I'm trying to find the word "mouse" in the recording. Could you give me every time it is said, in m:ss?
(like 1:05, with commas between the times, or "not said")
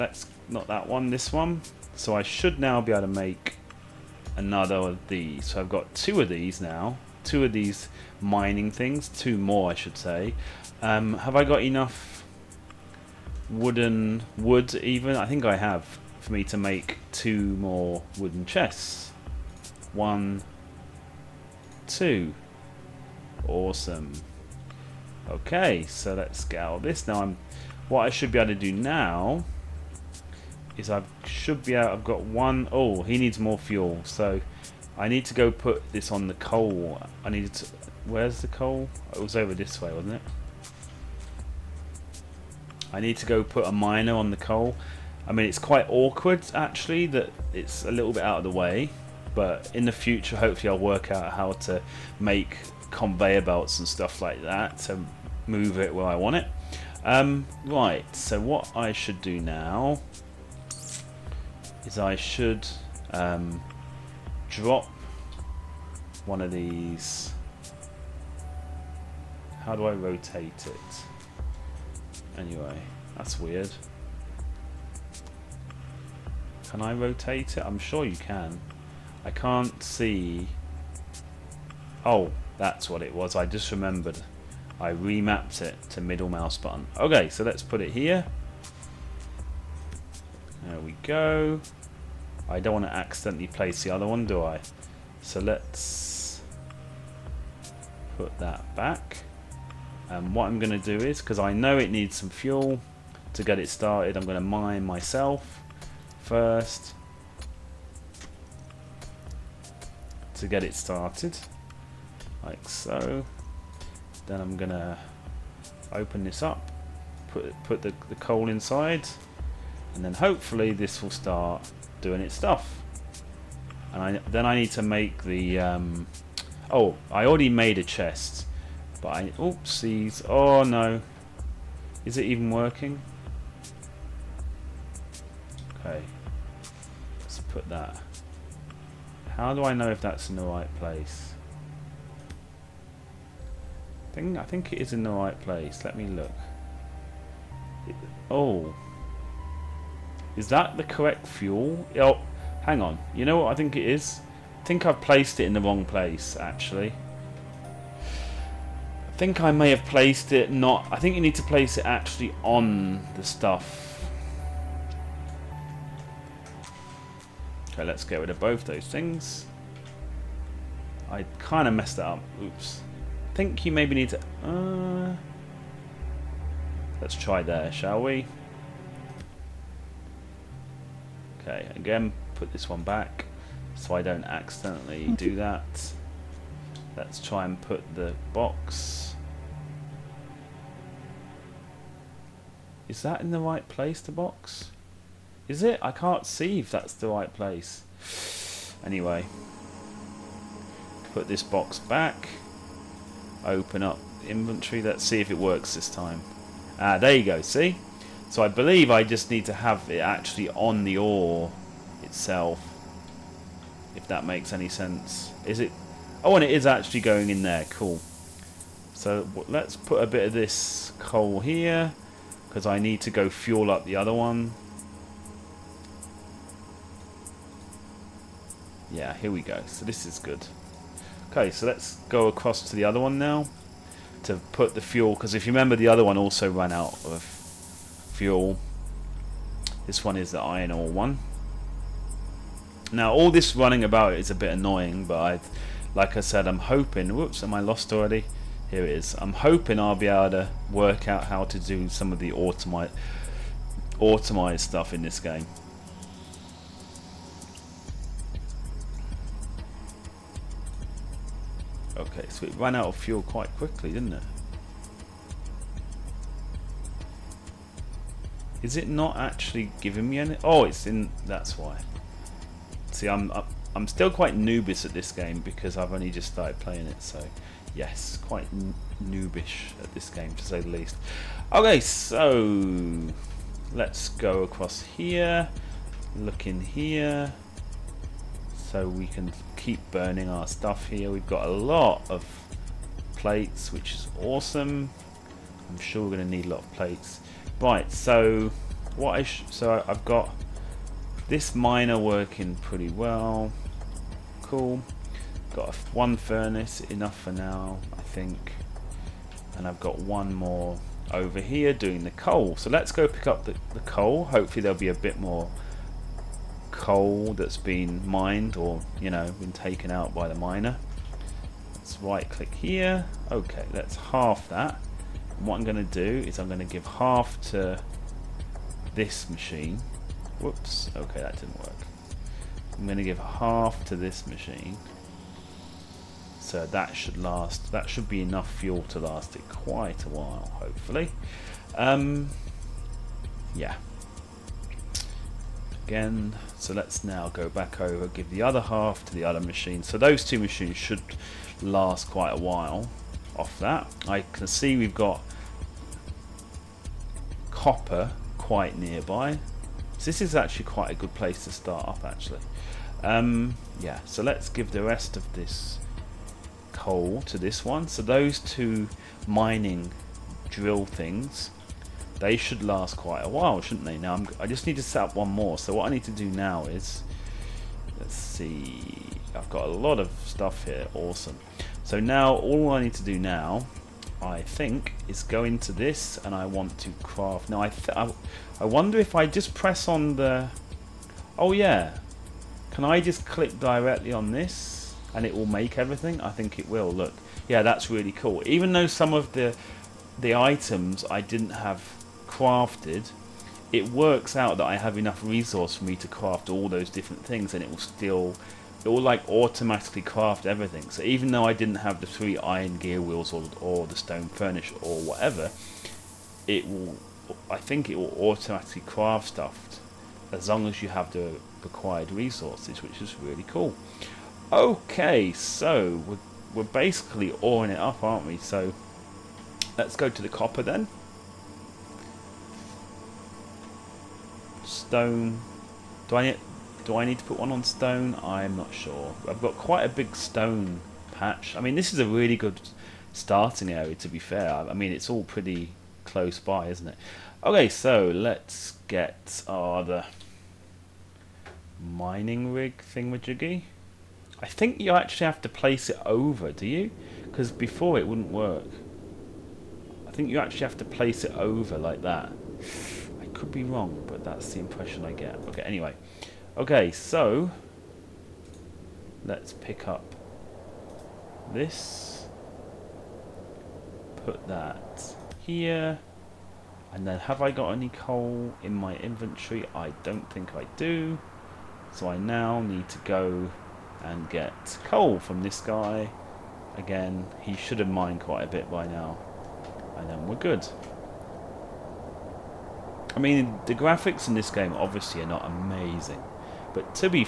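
1:26.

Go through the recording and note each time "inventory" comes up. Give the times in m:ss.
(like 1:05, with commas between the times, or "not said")
3:24, 7:58.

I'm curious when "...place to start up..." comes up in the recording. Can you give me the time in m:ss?
6:01.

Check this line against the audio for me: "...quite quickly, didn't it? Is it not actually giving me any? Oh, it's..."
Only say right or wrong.
right.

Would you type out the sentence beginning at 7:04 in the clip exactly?
Okay, so we're, we're basically awing it up, aren't we?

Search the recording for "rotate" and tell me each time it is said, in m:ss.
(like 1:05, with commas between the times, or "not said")
1:09, 1:16.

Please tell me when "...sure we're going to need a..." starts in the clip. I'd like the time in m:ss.
4:55.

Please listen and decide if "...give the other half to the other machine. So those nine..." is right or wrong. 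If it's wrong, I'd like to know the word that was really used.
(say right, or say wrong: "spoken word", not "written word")
wrong: "two", not "nine".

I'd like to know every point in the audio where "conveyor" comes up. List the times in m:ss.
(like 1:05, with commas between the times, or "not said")
0:52.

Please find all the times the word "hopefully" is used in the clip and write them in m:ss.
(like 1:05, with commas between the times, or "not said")
0:50, 2:00, 5:14, 5:40.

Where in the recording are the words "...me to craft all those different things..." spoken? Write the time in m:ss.
6:45.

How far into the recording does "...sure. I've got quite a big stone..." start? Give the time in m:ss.
7:18.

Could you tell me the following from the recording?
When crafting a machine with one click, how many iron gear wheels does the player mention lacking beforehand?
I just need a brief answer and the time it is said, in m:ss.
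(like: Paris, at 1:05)
3, at 6:52.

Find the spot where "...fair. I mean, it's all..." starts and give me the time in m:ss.
7:24.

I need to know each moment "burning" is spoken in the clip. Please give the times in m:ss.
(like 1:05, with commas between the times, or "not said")
4:49.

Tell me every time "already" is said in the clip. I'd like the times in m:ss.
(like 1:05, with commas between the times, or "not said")
2:07, 4:07.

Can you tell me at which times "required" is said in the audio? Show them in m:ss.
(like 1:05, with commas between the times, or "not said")
7:01.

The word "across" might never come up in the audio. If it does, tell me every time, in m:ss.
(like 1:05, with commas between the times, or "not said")
3:52, 4:44.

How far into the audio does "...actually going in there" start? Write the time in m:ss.
3:36.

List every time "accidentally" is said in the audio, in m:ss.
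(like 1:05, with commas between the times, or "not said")
1:32, 3:04.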